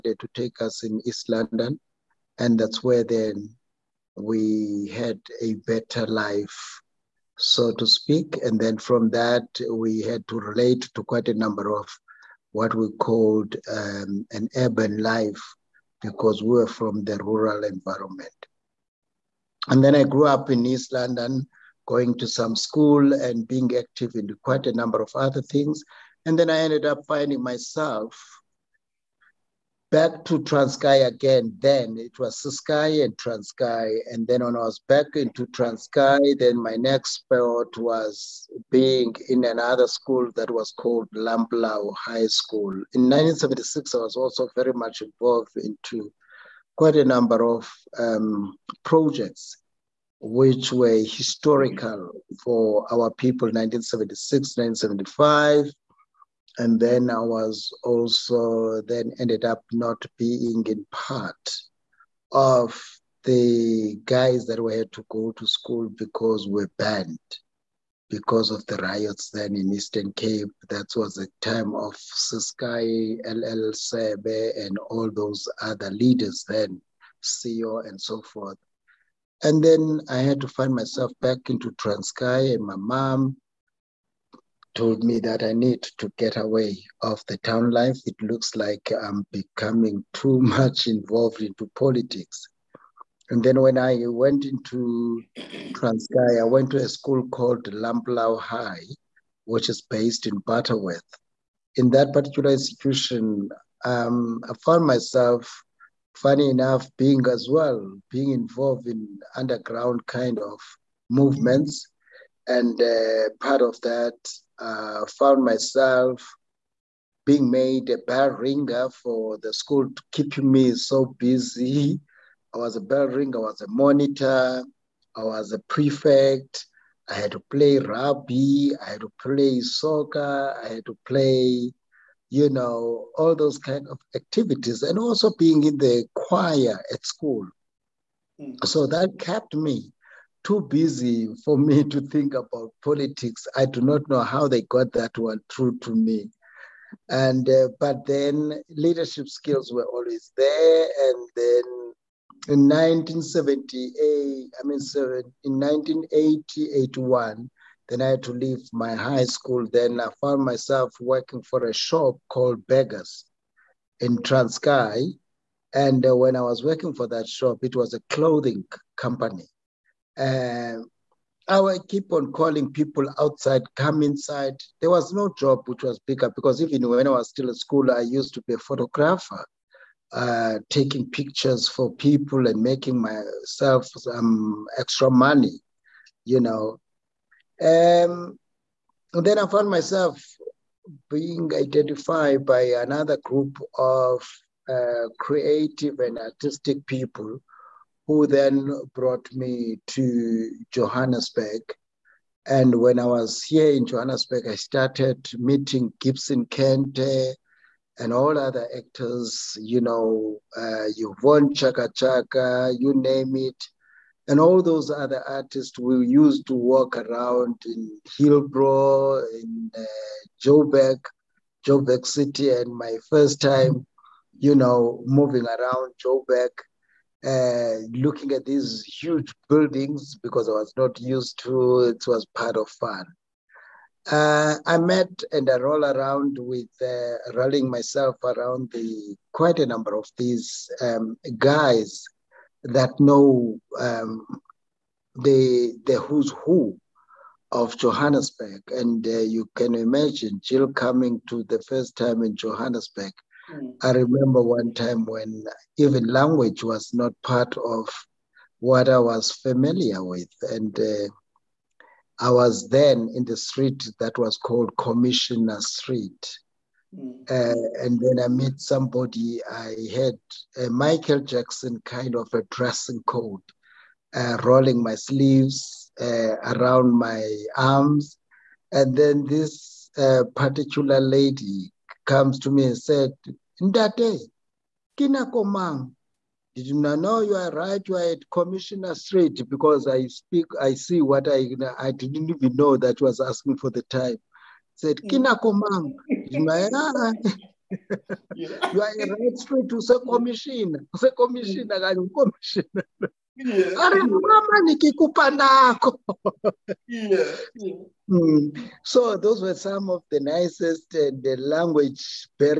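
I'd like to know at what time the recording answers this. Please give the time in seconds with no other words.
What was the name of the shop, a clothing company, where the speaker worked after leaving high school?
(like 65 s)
162 s.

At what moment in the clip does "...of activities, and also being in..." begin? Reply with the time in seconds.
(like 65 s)
133 s.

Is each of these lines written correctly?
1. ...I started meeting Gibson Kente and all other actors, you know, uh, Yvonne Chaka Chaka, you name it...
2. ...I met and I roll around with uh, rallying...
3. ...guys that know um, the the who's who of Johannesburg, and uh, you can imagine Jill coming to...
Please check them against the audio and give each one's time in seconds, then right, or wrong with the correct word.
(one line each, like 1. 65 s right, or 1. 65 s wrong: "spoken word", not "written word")
1. 204 s right
2. 234 s right
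3. 241 s right.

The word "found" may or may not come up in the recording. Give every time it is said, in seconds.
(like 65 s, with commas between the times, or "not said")
104 s, 115 s, 160 s, 189 s.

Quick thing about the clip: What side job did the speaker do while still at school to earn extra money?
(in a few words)
Photographer.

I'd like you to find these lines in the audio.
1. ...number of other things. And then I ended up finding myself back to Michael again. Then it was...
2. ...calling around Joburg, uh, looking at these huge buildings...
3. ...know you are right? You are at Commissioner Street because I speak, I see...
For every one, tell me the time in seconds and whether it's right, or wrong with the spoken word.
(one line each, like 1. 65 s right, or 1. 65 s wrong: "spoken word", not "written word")
1. 24 s wrong: "Transkei", not "Michael"
2. 225 s wrong: "moving", not "calling"
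3. 286 s right.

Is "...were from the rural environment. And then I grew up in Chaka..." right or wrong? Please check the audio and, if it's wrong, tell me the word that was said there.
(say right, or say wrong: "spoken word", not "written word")
wrong: "East", not "Chaka".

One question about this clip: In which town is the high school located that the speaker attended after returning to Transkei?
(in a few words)
Butterworth.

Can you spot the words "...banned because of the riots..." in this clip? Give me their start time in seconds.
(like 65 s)
66 s.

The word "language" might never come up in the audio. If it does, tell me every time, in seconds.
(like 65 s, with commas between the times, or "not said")
256 s, 311 s.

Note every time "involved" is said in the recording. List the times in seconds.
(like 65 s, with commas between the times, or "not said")
45 s, 90 s, 108 s.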